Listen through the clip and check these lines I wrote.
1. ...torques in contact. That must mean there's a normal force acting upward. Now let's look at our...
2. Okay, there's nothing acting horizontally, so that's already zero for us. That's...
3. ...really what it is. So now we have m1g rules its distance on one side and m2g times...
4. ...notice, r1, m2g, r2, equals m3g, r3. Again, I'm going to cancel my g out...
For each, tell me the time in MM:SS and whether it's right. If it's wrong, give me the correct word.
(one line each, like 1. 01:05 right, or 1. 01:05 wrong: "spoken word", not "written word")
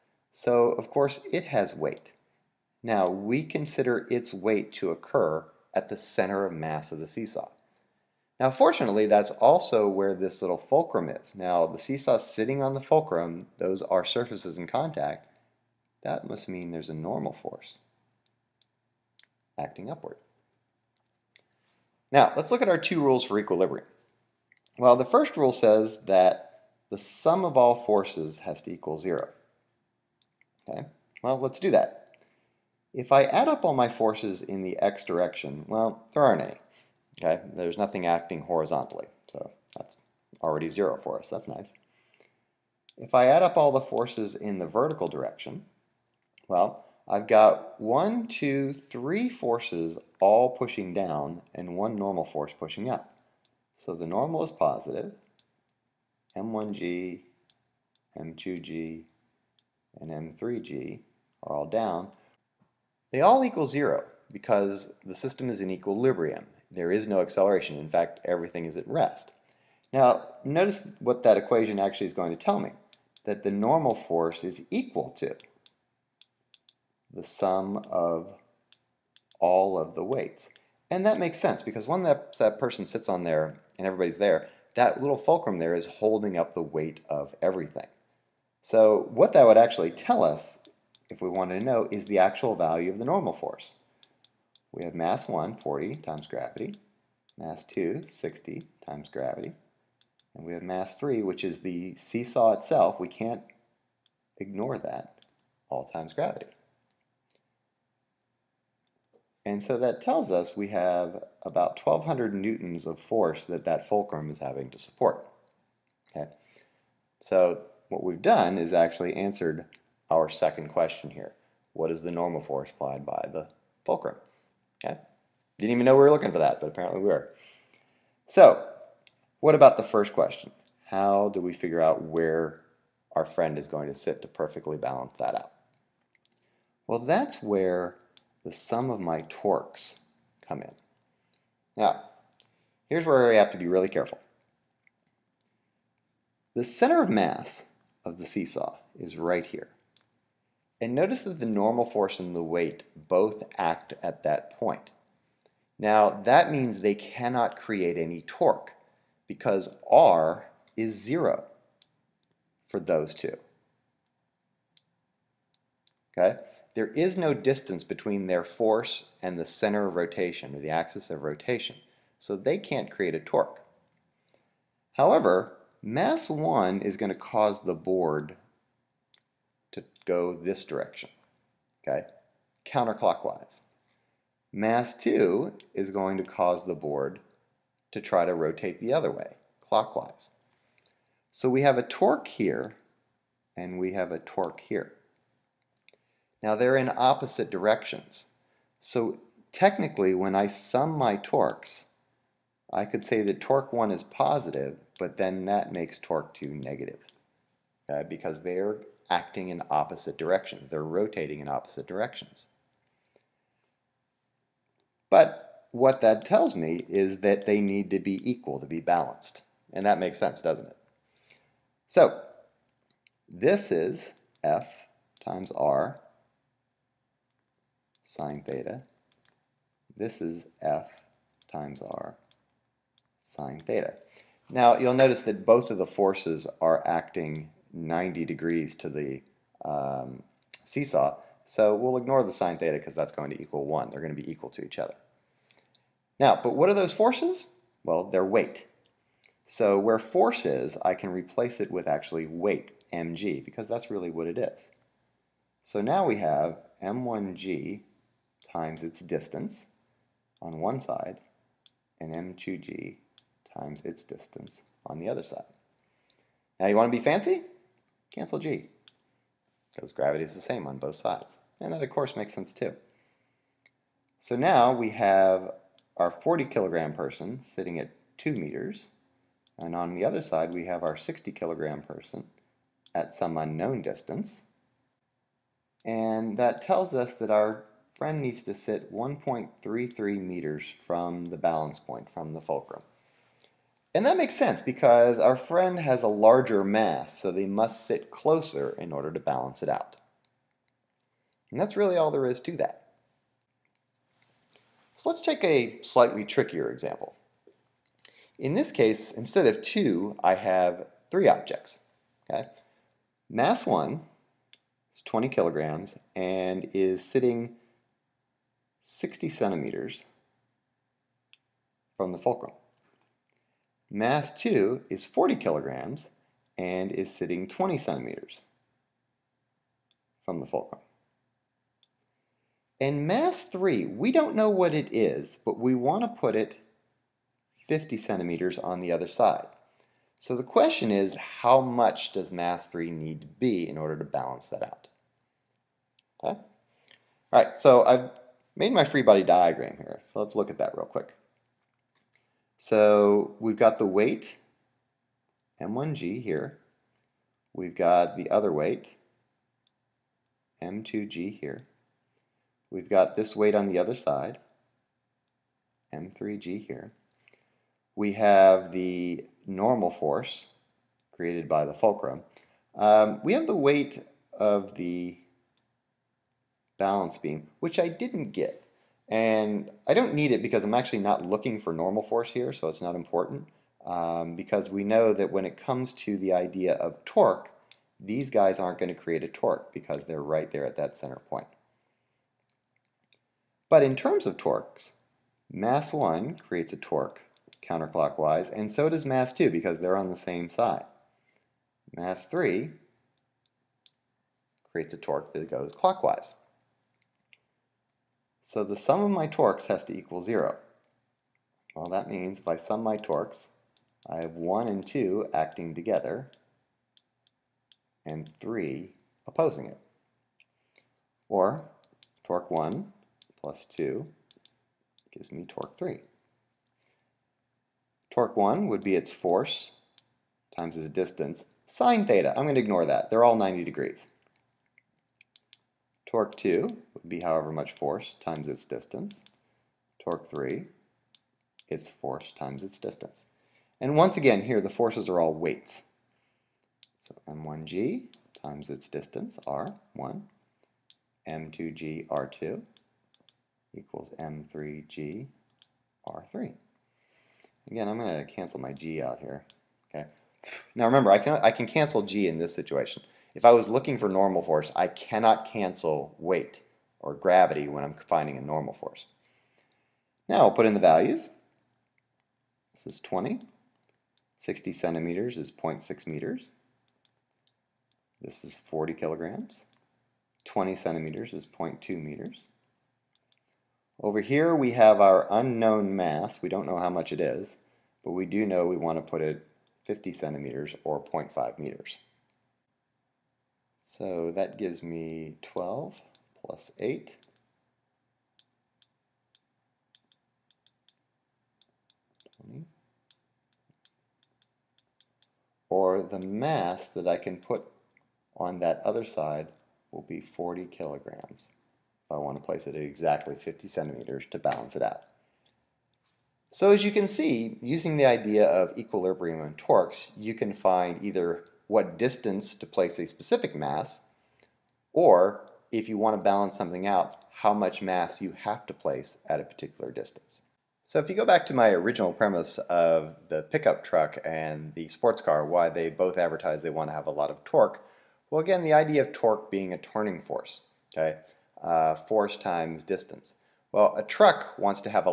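1. 00:14 wrong: "surfaces", not "torques"
2. 00:37 right
3. 04:13 wrong: "times", not "rules"
4. 07:28 wrong: "distance", not "notice".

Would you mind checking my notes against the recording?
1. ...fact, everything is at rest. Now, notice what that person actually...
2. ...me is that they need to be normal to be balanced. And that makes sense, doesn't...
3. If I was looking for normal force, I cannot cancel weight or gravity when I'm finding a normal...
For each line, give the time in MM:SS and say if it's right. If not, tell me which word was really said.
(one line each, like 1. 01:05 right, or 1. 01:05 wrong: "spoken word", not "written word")
1. 01:07 wrong: "equation", not "person"
2. 03:36 wrong: "equal", not "normal"
3. 07:43 right.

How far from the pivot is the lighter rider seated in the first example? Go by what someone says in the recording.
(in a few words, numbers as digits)
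2 meters.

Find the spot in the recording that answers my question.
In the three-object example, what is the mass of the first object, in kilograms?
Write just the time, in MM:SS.
05:15.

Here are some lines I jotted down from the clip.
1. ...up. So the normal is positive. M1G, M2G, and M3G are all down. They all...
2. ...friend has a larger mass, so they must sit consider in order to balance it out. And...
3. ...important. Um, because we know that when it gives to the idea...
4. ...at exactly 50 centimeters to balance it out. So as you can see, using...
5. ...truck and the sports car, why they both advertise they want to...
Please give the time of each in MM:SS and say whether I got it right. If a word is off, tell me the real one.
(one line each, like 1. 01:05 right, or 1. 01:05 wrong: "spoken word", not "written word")
1. 00:52 right
2. 04:55 wrong: "closer", not "consider"
3. 06:22 wrong: "comes", not "gives"
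4. 08:32 right
5. 08:53 right.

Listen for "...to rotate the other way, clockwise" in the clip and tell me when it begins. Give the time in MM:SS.
03:08.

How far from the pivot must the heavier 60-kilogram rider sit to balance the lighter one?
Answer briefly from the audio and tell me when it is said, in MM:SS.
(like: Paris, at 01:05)
1.33 meters, at 04:48.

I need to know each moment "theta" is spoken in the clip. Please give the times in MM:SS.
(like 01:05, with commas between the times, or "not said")
03:48, 03:53, 04:02, 07:12.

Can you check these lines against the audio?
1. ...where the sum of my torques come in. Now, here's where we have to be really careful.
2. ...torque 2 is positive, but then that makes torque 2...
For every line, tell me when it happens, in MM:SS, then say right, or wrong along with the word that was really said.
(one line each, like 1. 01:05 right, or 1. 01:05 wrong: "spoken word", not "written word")
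1. 02:17 right
2. 03:23 wrong: "1", not "2".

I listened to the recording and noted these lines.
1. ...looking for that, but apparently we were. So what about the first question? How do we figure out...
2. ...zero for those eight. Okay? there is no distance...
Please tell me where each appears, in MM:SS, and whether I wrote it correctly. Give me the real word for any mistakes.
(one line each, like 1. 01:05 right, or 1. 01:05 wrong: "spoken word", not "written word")
1. 02:06 right
2. 02:40 wrong: "two", not "eight".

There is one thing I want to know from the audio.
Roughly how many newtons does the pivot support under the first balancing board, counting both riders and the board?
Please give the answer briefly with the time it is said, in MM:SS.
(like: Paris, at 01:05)
1200 newtons, at 01:51.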